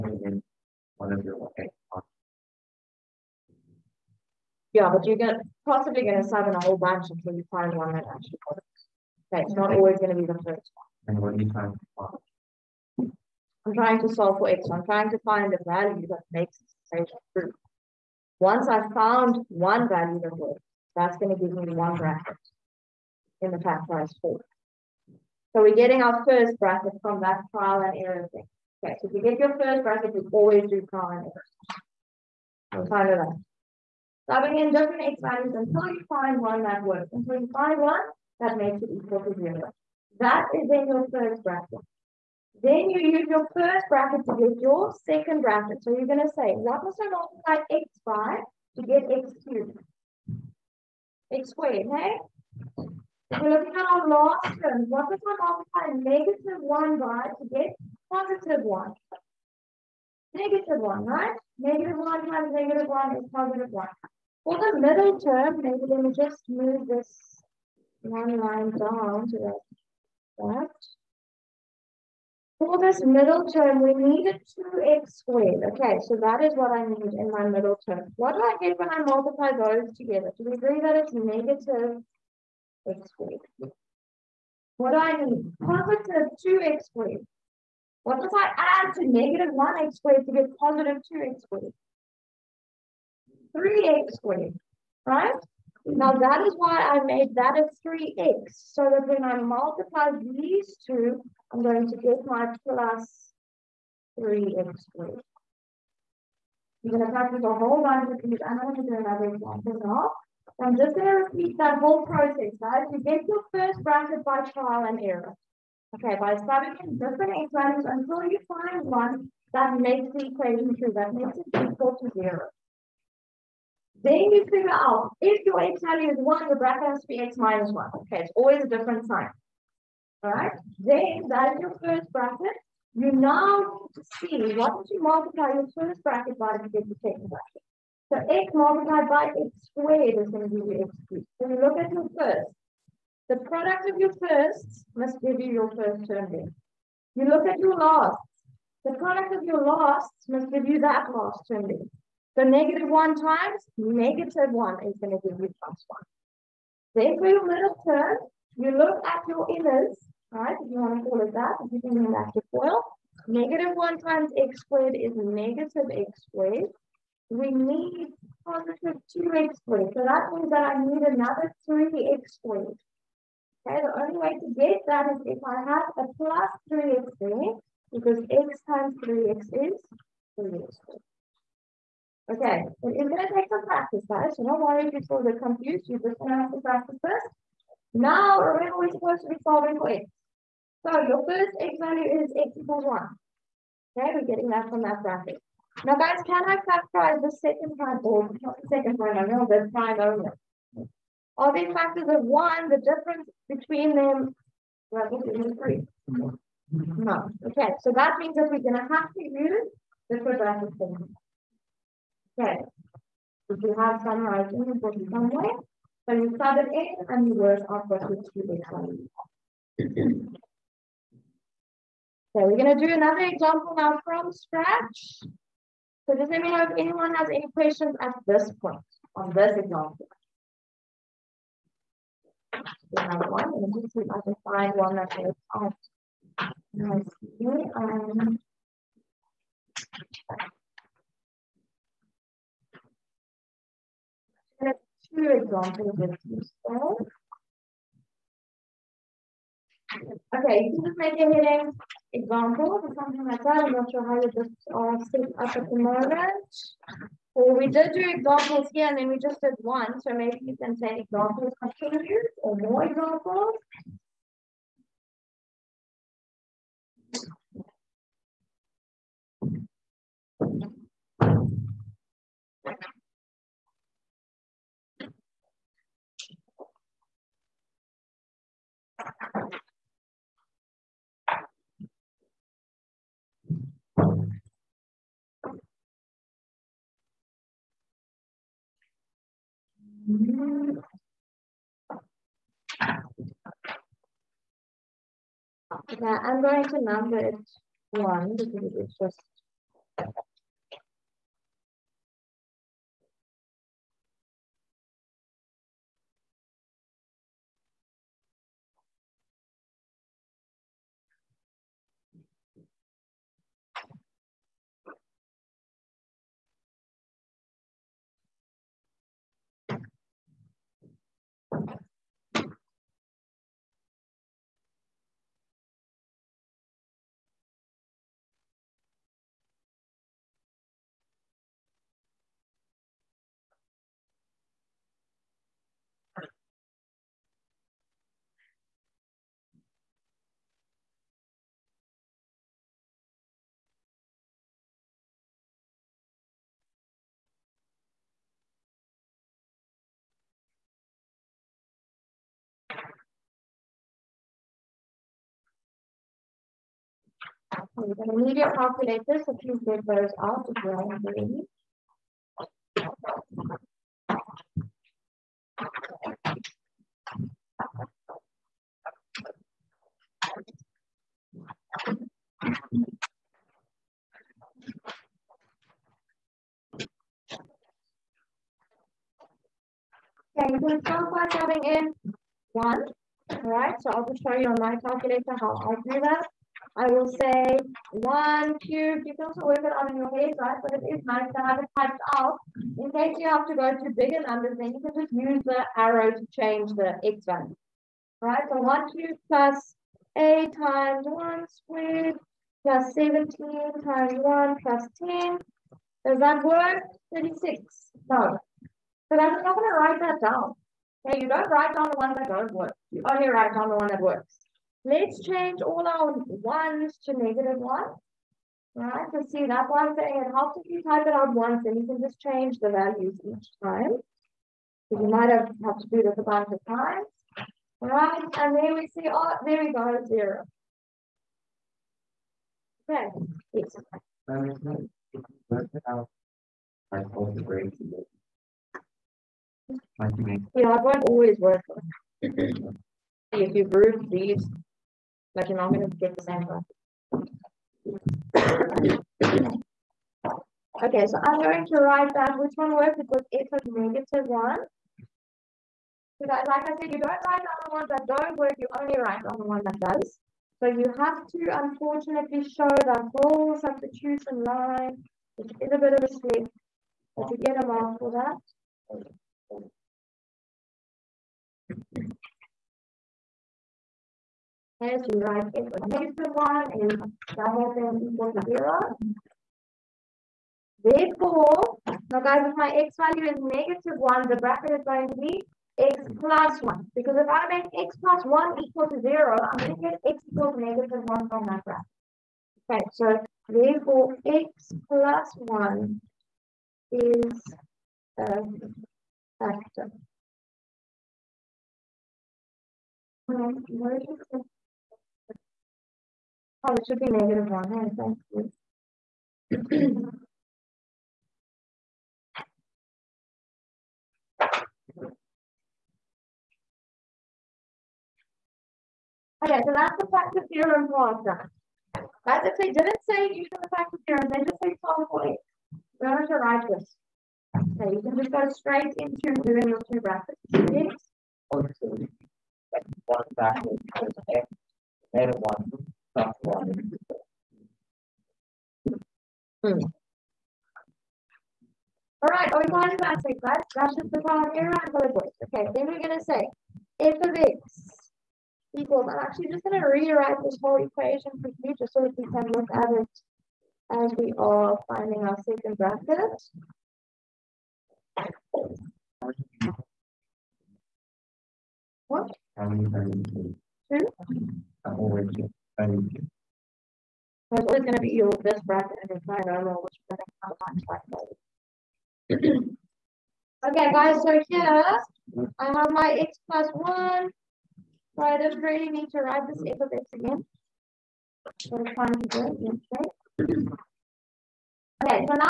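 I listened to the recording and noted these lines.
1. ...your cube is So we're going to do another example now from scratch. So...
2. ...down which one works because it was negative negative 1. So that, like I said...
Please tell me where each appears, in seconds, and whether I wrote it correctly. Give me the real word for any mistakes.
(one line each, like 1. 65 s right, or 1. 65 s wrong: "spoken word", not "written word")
1. 218 s right
2. 452 s right.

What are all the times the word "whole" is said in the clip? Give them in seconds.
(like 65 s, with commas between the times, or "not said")
6 s, 107 s, 111 s, 463 s, 550 s.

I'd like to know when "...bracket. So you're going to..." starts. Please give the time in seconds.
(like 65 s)
45 s.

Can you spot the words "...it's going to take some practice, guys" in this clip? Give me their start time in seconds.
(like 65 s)
182 s.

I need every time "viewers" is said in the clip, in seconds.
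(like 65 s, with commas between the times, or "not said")
not said.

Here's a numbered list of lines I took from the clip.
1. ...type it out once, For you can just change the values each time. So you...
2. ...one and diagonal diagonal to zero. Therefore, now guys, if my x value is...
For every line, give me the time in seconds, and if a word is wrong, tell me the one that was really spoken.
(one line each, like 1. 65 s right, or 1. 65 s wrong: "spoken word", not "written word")
1. 420 s wrong: "And", not "For"
2. 476 s wrong: "equal", not "diagonal".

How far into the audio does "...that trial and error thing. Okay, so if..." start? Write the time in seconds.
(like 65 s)
27 s.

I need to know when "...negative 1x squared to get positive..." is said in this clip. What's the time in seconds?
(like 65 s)
89 s.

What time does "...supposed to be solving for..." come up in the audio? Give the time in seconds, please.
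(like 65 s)
188 s.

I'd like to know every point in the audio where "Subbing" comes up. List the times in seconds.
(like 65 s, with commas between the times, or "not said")
34 s.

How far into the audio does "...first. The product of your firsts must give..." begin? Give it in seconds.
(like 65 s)
142 s.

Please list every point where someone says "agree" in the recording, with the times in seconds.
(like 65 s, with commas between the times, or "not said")
80 s.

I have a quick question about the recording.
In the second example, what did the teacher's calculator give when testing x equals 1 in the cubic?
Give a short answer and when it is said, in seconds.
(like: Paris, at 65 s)
36, at 407 s.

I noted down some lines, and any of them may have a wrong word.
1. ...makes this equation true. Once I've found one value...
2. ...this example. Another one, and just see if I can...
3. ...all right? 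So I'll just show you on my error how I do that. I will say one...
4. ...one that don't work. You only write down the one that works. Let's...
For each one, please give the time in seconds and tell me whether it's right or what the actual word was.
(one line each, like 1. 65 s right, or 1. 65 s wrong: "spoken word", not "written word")
1. 16 s right
2. 229 s right
3. 383 s wrong: "calculator", not "error"
4. 412 s right.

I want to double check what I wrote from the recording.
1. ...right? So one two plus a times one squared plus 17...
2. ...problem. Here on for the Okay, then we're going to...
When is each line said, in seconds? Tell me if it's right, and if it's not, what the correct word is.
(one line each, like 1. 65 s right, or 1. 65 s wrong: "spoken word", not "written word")
1. 398 s right
2. 544 s right.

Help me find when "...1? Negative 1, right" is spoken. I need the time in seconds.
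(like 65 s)
58 s.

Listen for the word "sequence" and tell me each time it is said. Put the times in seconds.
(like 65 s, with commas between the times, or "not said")
not said.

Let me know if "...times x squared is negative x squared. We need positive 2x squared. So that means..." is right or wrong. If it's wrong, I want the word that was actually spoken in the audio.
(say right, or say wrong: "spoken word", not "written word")
right.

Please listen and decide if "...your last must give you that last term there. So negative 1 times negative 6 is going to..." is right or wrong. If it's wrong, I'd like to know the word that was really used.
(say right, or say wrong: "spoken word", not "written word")
wrong: "1", not "6".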